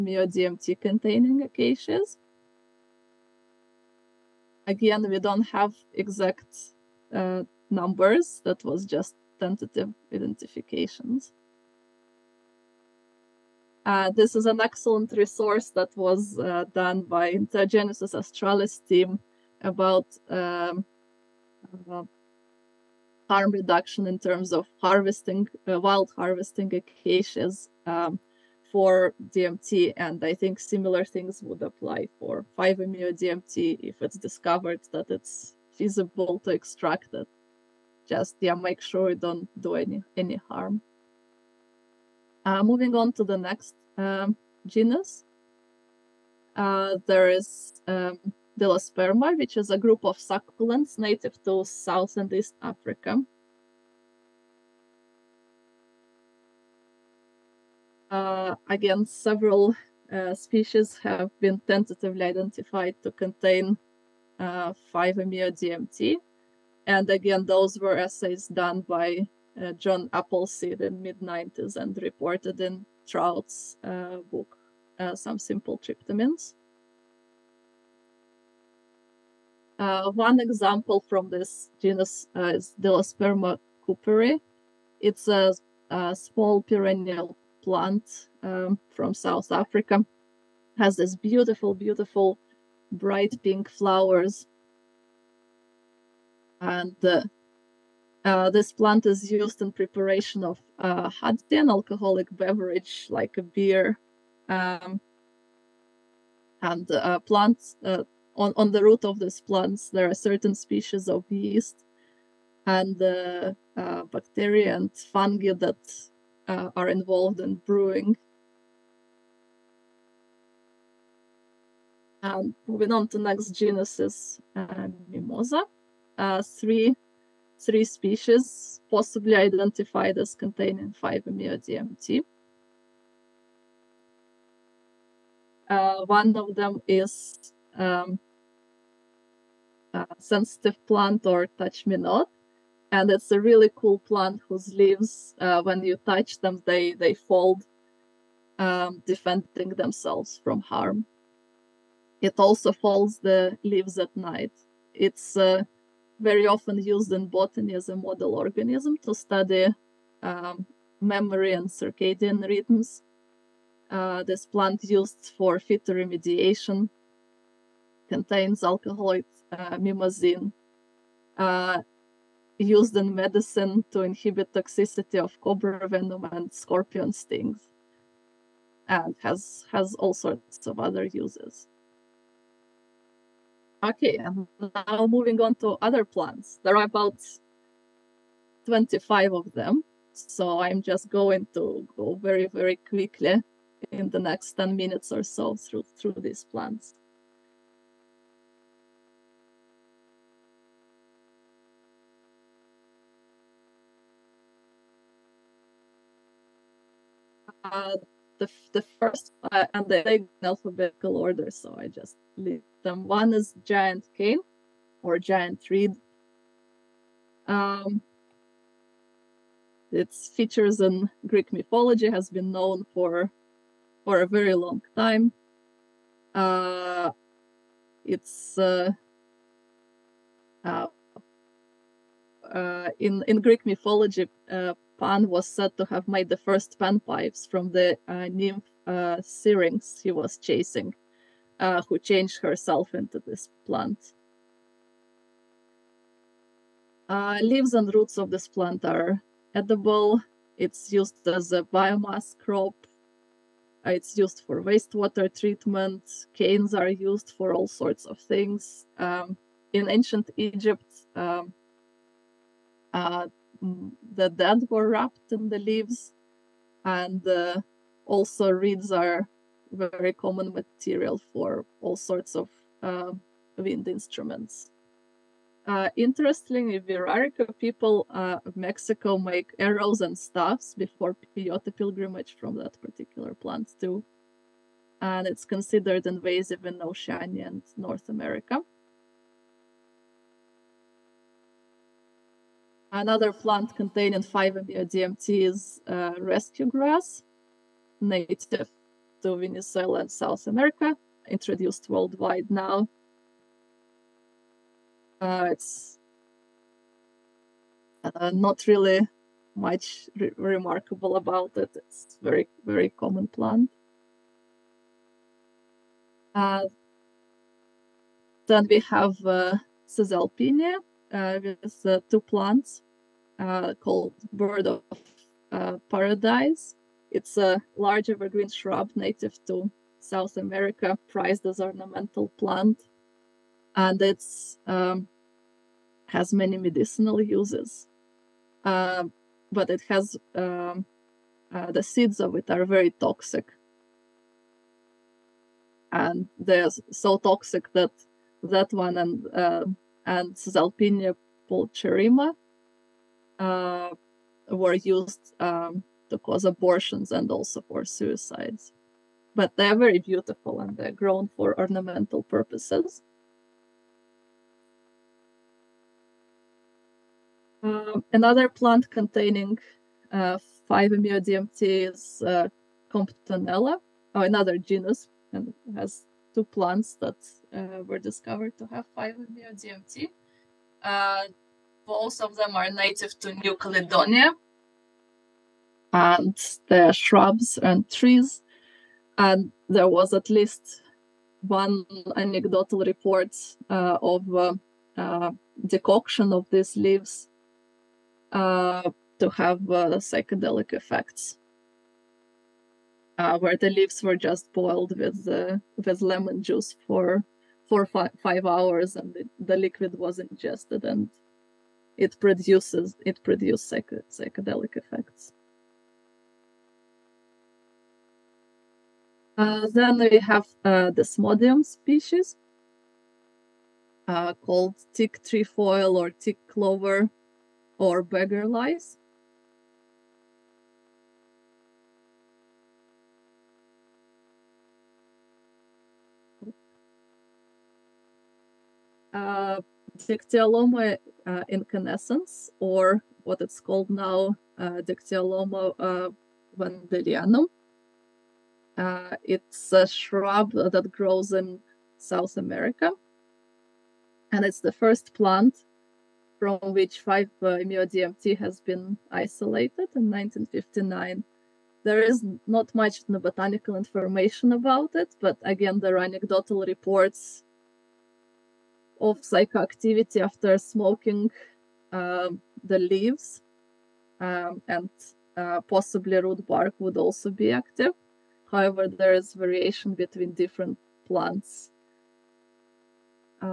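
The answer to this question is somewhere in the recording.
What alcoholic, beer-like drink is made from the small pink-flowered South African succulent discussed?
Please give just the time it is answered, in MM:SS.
01:41.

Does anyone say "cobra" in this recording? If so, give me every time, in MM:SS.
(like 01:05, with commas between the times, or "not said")
02:55.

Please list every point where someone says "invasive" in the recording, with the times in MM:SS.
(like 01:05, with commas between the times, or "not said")
04:46.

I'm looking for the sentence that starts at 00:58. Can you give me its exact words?
Uh, again, several uh, species have been tentatively identified to contain 5-MeO uh, DMT.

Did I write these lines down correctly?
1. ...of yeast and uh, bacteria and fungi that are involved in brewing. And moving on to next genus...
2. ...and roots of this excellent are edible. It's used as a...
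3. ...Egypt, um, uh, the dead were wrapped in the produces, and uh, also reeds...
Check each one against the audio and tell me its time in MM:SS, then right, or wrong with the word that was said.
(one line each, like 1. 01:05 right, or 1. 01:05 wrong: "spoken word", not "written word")
1. 01:51 right
2. 04:07 wrong: "plant", not "excellent"
3. 04:20 wrong: "leaves", not "produces".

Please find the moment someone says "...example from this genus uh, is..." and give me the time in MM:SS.
01:20.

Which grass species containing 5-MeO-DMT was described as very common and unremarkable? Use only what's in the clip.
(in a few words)
rescue grass.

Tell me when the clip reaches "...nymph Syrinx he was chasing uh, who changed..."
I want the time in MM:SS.
03:58.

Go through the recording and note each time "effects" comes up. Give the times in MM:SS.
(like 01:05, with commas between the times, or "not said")
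06:40, 06:54.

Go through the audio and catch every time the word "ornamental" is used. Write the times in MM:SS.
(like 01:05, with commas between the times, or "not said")
05:31, 06:01.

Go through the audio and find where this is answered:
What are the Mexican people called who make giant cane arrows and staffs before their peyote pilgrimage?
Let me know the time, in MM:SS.
04:36.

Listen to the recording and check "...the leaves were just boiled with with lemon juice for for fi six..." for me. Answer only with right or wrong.
wrong.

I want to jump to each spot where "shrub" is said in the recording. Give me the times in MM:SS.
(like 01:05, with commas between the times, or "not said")
05:28, 06:26, 07:29.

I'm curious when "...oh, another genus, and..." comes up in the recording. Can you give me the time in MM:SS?
06:14.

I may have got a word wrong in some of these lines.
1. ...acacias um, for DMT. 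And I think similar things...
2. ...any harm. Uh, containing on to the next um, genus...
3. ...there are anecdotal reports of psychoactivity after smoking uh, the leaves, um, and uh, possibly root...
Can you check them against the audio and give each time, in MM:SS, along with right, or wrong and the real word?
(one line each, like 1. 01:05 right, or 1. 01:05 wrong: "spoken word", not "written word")
1. 00:26 right
2. 00:40 wrong: "moving", not "containing"
3. 07:45 right.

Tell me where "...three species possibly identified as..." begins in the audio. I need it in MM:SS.
02:07.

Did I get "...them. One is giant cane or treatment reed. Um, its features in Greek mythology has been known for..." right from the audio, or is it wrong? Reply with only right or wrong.
wrong.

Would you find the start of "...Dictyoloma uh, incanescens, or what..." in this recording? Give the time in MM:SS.
07:19.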